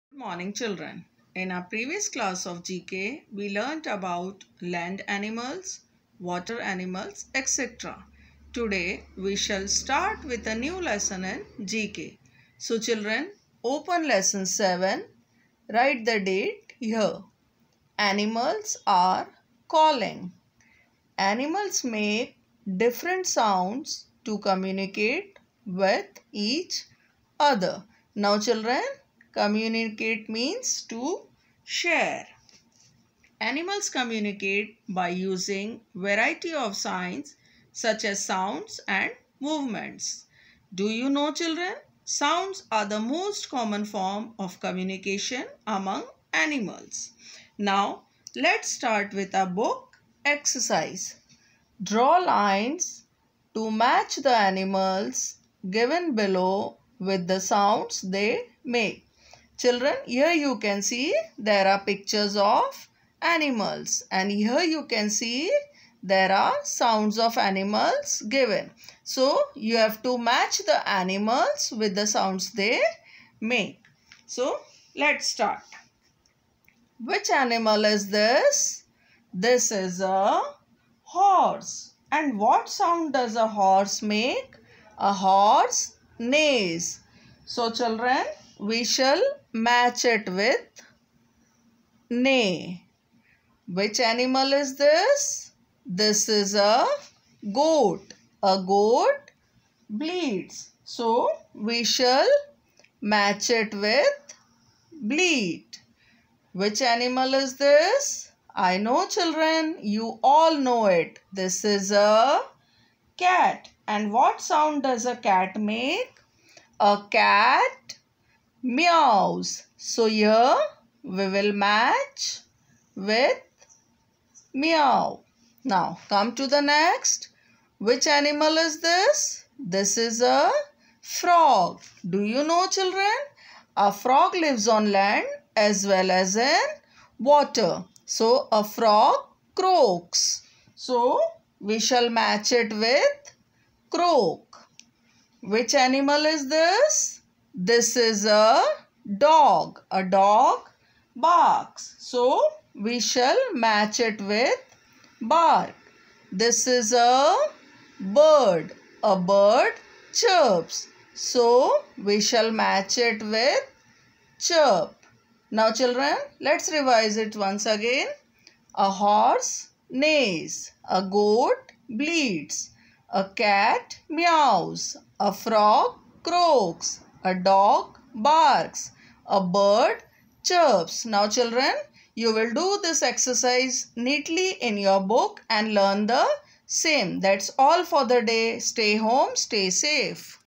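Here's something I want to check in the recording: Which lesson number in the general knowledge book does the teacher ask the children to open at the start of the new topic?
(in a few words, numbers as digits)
7.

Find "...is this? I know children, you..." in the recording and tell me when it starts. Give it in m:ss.
1:47.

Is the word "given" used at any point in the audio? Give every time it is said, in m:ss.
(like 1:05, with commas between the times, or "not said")
0:55, 1:08.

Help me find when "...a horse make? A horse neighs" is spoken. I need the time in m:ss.
1:23.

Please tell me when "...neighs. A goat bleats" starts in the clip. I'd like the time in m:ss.
2:49.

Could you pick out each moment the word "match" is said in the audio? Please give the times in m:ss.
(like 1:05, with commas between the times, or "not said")
0:53, 1:10, 1:29, 1:43, 2:01, 2:22, 2:33, 2:42.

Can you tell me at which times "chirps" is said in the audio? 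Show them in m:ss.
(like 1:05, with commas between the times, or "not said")
2:40, 2:44, 3:00.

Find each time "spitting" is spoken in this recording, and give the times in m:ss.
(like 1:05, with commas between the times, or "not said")
not said.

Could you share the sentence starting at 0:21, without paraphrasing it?
Animals make different sounds to communicate with each other.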